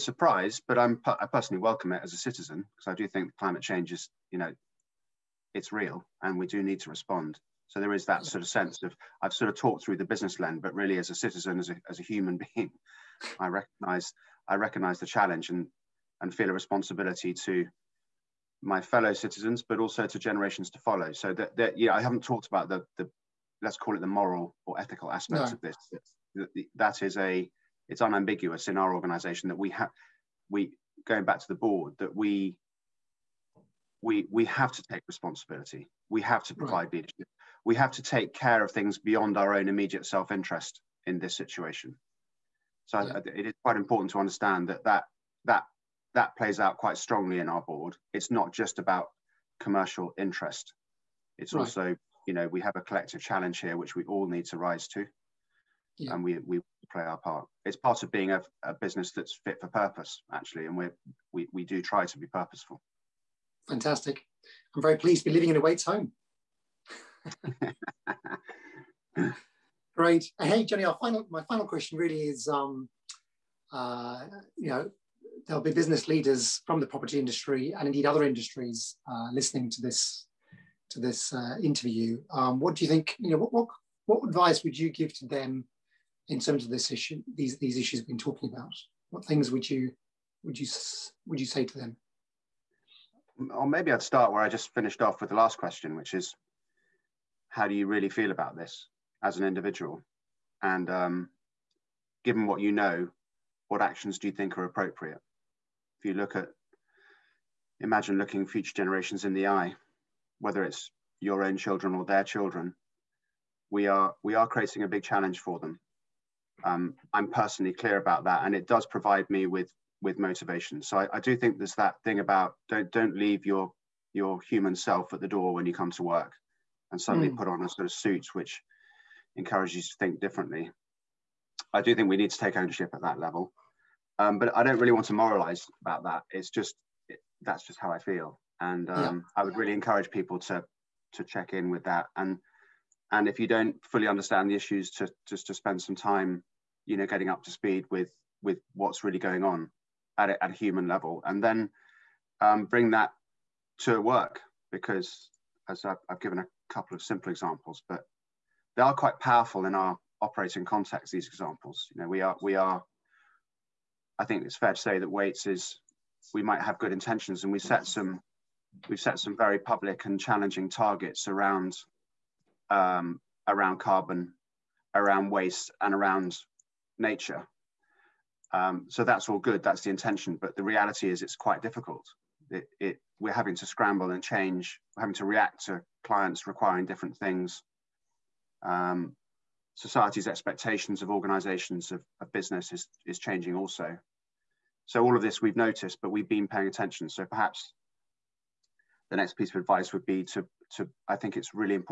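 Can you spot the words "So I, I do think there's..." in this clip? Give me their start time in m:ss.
2:00.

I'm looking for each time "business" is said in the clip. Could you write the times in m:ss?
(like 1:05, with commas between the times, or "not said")
0:10, 0:58, 1:15, 3:12.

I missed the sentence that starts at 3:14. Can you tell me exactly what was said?
So all of this we've noticed, but we've been paying attention.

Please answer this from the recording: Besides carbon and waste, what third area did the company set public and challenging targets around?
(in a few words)
Nature.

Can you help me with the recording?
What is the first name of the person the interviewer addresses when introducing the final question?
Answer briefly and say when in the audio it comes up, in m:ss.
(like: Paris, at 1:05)
Jenny, at 1:10.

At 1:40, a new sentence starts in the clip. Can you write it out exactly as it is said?
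And um, given what you know, what actions do you think are appropriate?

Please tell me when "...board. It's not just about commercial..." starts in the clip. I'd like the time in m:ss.
0:47.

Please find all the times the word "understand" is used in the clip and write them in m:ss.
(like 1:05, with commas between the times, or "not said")
0:44, 2:24.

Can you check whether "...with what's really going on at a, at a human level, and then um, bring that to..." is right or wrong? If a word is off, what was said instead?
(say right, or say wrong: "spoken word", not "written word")
right.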